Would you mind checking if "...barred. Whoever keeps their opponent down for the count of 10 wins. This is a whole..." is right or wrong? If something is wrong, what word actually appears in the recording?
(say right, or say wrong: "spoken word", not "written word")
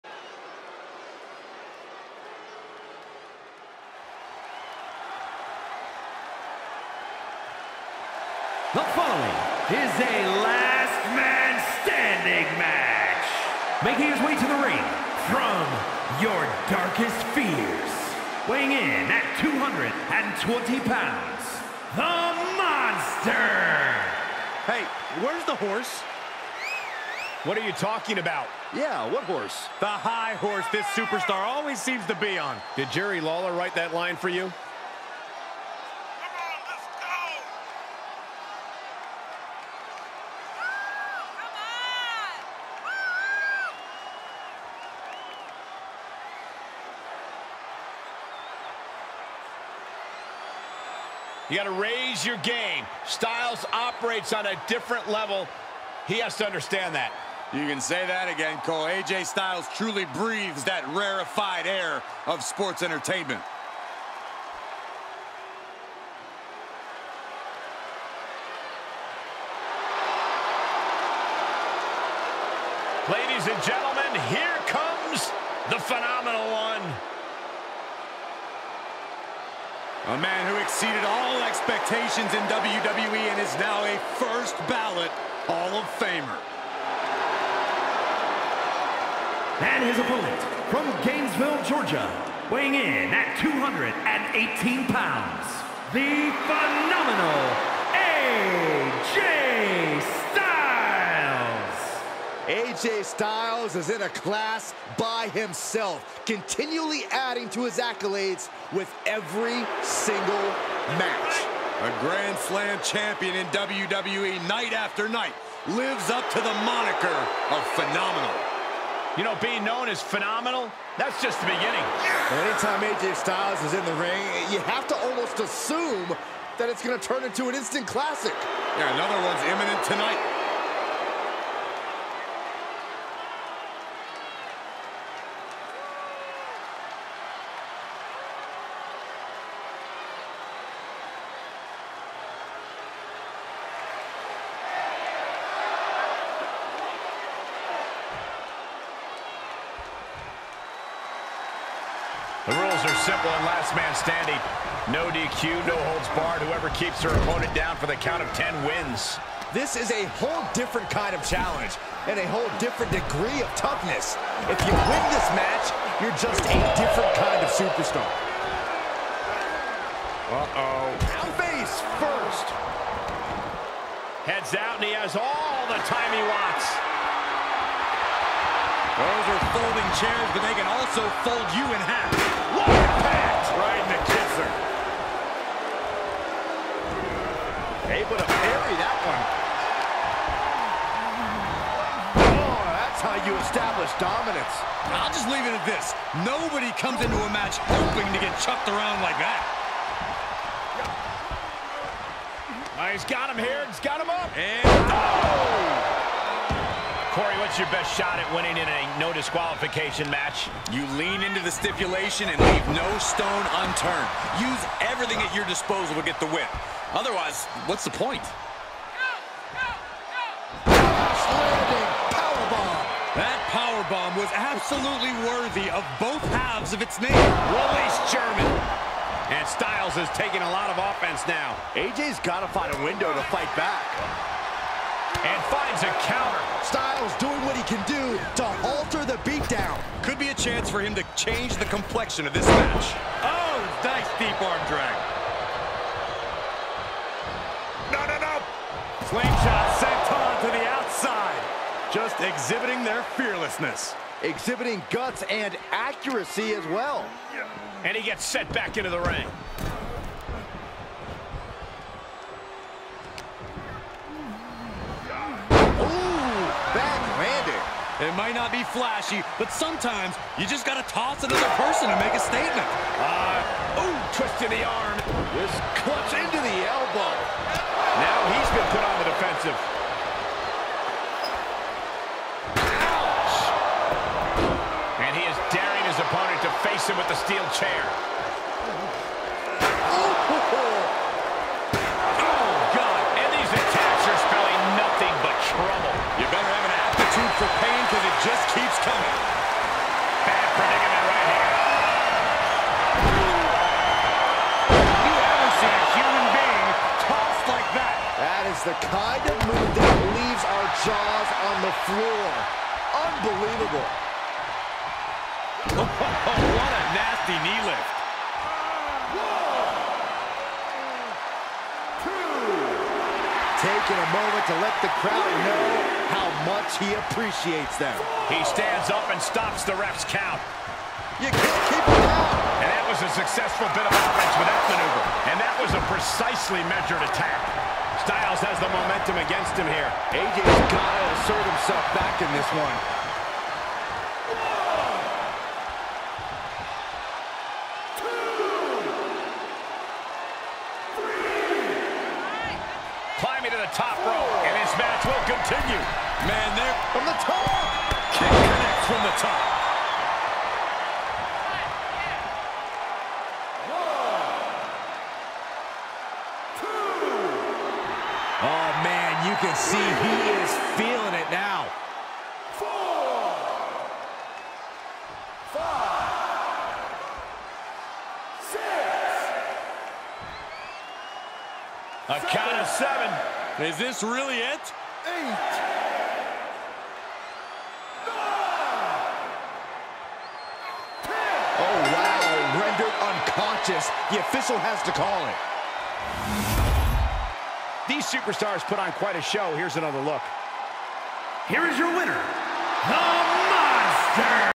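right.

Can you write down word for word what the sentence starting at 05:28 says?
He stands up and stops the ref's count.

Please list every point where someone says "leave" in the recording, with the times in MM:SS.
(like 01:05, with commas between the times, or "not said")
03:15, 03:32, 05:10.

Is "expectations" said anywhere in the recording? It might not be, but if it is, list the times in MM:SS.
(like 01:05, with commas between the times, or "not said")
01:21.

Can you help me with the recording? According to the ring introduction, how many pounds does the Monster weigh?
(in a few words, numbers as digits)
220.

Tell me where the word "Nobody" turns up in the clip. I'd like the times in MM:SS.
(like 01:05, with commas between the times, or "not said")
03:16.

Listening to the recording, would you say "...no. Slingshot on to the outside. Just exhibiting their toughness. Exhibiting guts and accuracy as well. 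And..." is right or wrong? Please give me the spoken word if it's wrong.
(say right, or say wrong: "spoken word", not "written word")
wrong: "fearlessness", not "toughness".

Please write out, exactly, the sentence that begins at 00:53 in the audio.
Styles operates on a different level.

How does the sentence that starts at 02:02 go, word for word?
Anytime AJ Styles is in the ring, you have to almost assume that it's going to turn into an instant classic.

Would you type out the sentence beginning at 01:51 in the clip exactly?
A Grand Slam champion in WWE night after night lives up to the moniker of phenomenal.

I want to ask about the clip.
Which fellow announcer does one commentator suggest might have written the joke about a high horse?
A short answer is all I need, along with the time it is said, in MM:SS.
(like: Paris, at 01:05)
Jerry Lawler, at 00:32.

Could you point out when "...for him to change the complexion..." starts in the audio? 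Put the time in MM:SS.
04:00.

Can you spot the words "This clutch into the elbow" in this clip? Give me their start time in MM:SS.
04:35.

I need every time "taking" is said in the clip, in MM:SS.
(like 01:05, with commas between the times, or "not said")
03:50, 05:23.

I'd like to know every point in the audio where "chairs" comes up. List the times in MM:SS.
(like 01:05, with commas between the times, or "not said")
02:59, 04:47.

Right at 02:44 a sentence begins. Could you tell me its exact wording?
If you win this match, you're just a different kind of superstar.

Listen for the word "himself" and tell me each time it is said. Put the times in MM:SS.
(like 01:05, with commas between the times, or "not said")
01:45, 05:41.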